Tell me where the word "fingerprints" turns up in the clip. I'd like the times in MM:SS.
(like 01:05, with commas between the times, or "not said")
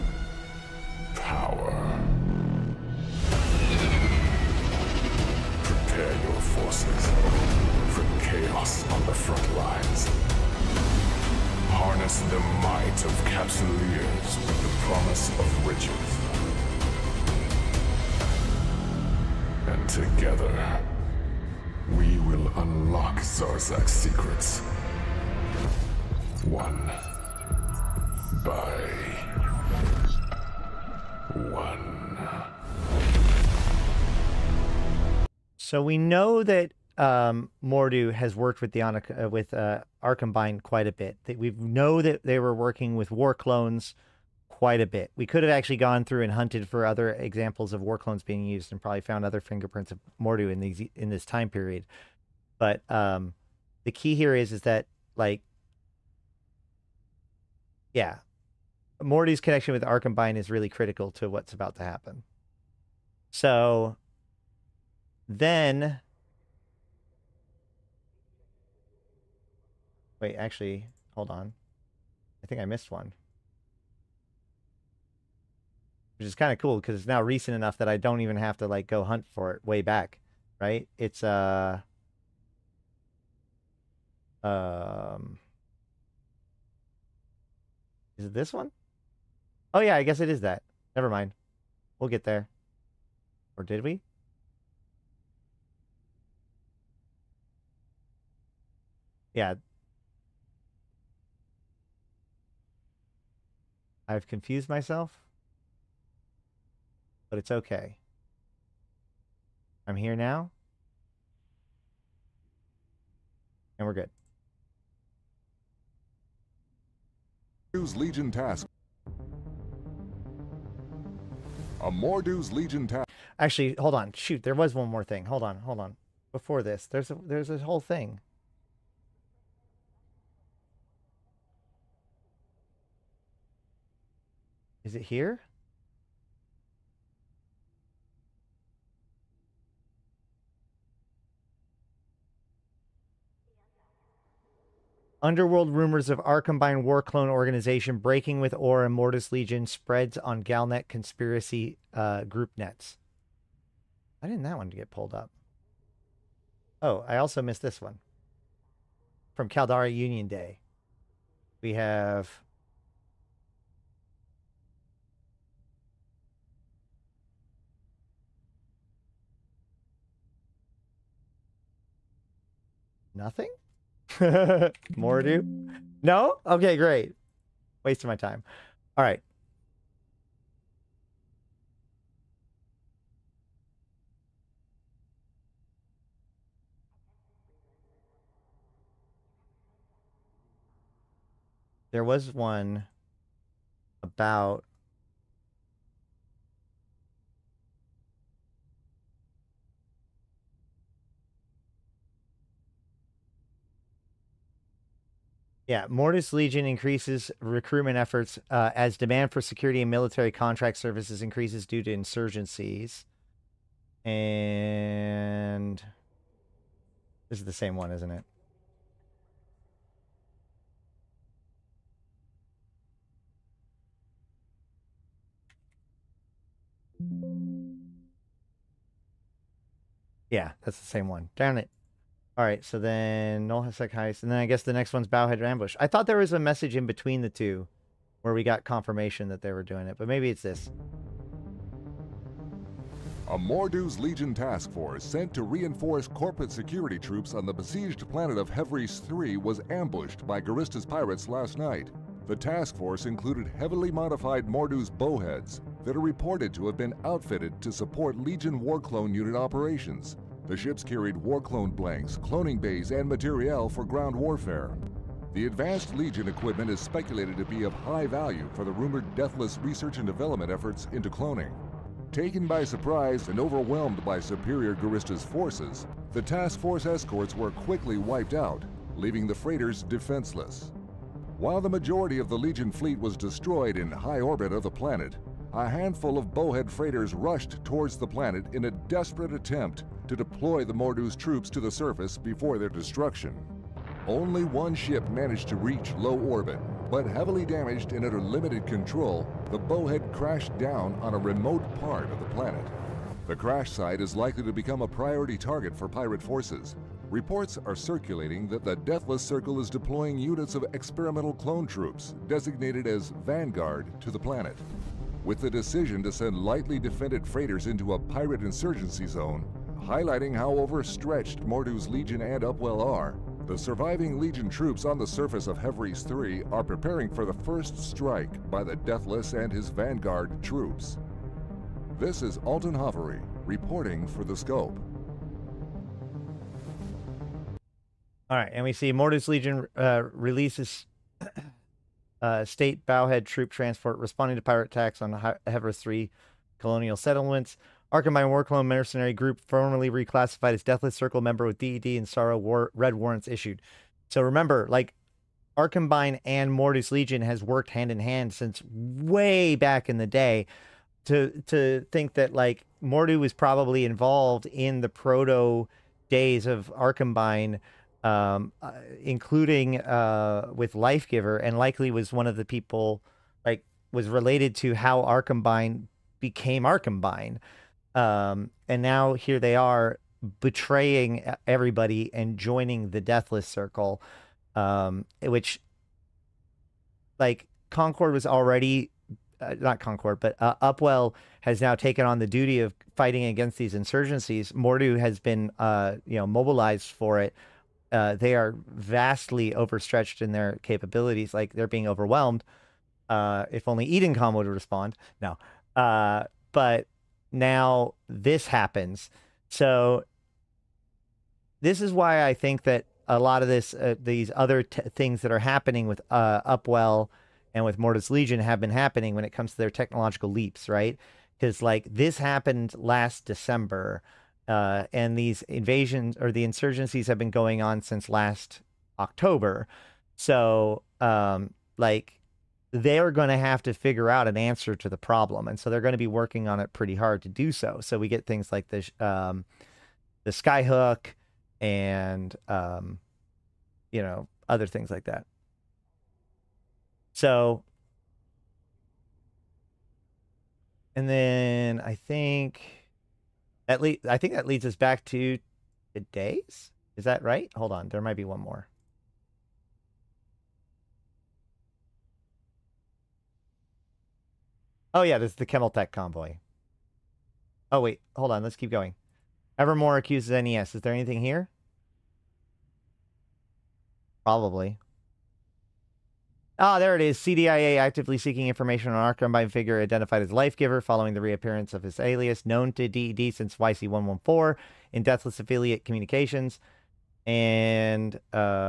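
00:49.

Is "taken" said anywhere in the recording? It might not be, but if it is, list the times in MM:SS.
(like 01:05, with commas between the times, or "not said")
04:32, 06:31.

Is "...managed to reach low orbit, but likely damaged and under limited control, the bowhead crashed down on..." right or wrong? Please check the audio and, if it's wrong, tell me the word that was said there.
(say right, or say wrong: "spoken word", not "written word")
wrong: "heavily", not "likely".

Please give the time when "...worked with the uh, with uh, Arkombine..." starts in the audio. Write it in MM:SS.
00:38.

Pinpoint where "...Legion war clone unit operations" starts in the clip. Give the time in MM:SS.
04:18.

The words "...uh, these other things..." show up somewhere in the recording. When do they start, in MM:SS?
06:53.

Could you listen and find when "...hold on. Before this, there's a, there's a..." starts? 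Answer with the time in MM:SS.
02:05.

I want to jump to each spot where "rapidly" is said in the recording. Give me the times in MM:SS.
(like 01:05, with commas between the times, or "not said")
not said.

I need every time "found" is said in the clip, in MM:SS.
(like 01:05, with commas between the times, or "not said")
00:49.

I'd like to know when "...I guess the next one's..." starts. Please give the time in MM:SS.
03:54.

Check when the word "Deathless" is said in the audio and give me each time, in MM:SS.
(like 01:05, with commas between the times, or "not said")
04:29, 05:08, 05:28, 05:50, 06:23, 08:05.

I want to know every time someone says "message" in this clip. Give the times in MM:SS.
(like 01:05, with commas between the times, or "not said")
03:56.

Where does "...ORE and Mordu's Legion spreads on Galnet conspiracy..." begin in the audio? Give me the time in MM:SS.
02:28.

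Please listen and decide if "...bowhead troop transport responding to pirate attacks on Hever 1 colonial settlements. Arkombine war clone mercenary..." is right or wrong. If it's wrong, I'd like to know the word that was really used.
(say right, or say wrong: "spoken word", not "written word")
wrong: "3", not "1".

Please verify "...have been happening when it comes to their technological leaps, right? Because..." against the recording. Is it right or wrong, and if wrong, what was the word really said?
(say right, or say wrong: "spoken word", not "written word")
right.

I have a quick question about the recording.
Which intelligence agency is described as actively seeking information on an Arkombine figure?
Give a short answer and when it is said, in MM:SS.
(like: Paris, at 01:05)
CDIA, at 07:57.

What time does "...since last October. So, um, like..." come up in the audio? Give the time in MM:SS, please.
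07:07.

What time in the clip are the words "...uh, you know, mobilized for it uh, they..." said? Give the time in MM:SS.
06:35.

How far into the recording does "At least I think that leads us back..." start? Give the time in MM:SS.
07:33.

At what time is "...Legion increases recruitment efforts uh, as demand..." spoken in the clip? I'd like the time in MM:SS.
03:26.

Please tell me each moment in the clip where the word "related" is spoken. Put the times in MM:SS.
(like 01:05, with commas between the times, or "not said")
06:14.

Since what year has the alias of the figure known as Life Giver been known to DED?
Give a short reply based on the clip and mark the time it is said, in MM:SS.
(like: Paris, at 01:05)
YC114, at 08:03.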